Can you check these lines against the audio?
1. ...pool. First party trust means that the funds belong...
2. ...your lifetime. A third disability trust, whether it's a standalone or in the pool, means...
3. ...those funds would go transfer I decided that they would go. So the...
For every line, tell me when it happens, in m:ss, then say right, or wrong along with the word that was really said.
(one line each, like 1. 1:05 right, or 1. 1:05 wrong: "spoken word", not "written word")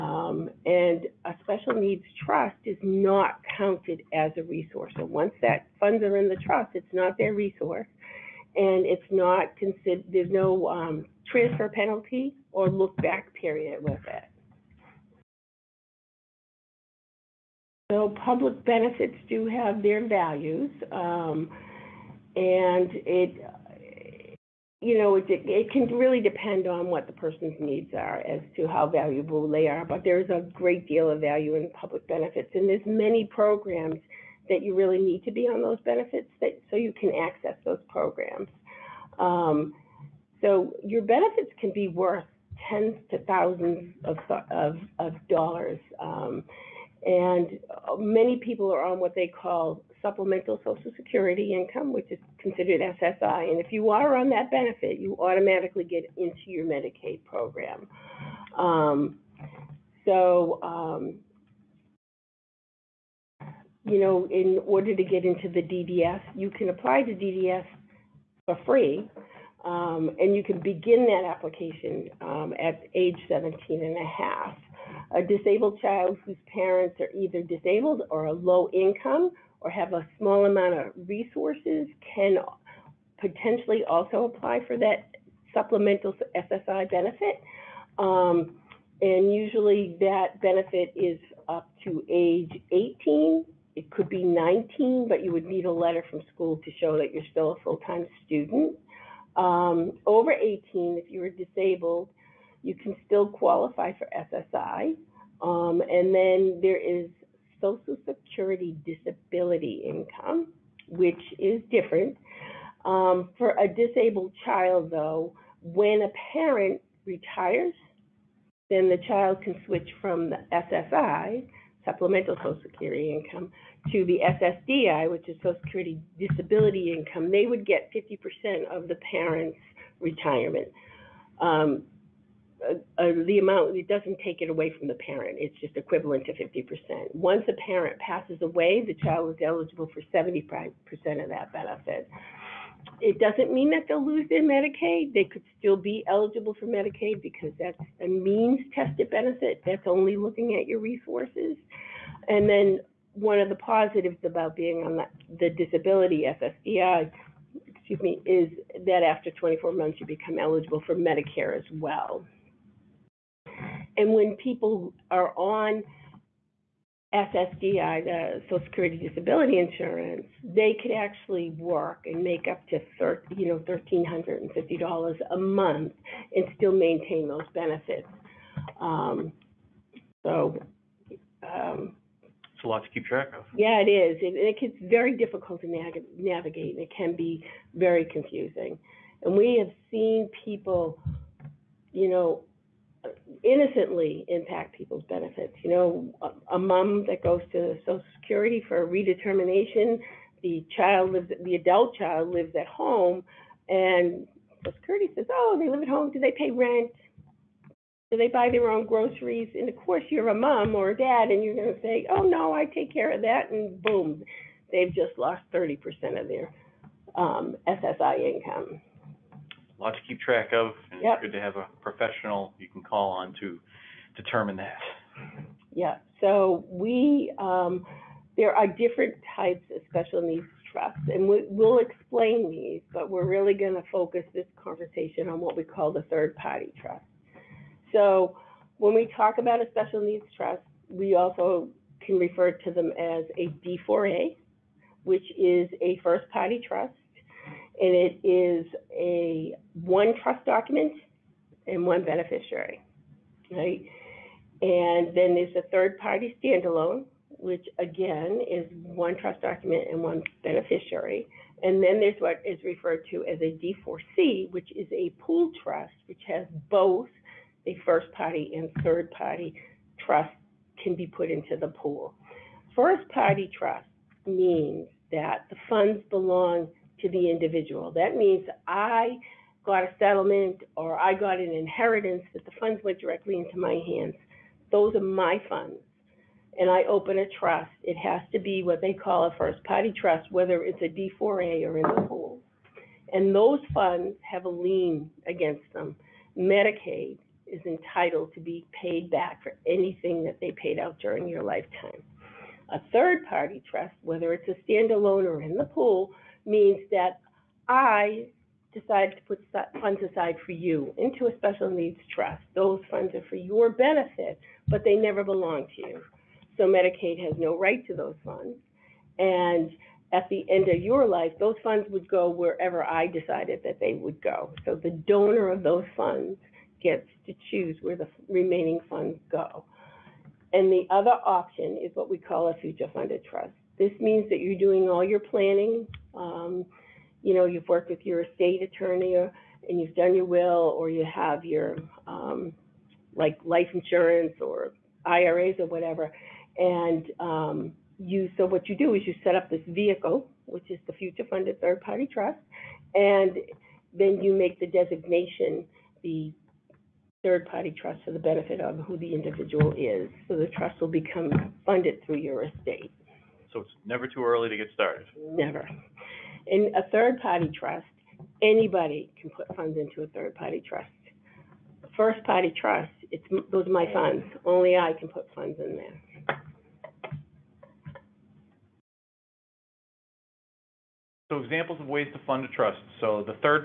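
1. 4:31 right
2. 5:01 wrong: "party", not "disability"
3. 5:21 wrong: "wherever", not "transfer".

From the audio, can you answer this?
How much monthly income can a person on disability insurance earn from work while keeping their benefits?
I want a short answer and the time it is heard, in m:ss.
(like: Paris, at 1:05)
$1,350, at 2:53.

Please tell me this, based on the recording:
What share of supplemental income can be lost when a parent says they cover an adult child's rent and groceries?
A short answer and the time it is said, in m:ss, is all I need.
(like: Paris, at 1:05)
30%, at 3:35.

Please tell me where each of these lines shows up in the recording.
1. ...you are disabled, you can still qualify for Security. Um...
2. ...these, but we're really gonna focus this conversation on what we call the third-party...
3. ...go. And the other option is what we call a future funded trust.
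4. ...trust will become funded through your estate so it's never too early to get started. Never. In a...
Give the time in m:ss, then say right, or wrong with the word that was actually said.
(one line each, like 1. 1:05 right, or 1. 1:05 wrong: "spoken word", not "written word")
1. 1:41 wrong: "SSI", not "Security"
2. 3:52 right
3. 5:29 right
4. 6:00 right.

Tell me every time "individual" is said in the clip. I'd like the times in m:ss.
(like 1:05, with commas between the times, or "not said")
4:37, 5:59.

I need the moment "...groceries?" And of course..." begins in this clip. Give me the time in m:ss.
3:28.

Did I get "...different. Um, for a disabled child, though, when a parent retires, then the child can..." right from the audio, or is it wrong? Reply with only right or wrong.
right.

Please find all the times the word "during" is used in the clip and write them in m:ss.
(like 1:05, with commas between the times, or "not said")
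5:01.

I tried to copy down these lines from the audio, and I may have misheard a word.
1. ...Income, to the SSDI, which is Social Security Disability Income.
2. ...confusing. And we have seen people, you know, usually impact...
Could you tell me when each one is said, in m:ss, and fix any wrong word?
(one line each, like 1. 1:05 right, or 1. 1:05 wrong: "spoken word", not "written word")
1. 2:03 right
2. 3:08 wrong: "innocently", not "usually".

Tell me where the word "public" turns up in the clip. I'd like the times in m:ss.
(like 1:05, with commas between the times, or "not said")
0:18, 0:31.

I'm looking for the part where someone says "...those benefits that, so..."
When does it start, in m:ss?
0:35.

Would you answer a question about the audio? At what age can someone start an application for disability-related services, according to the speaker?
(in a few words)
17 and a half.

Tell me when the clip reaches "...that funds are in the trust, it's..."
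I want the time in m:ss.
0:05.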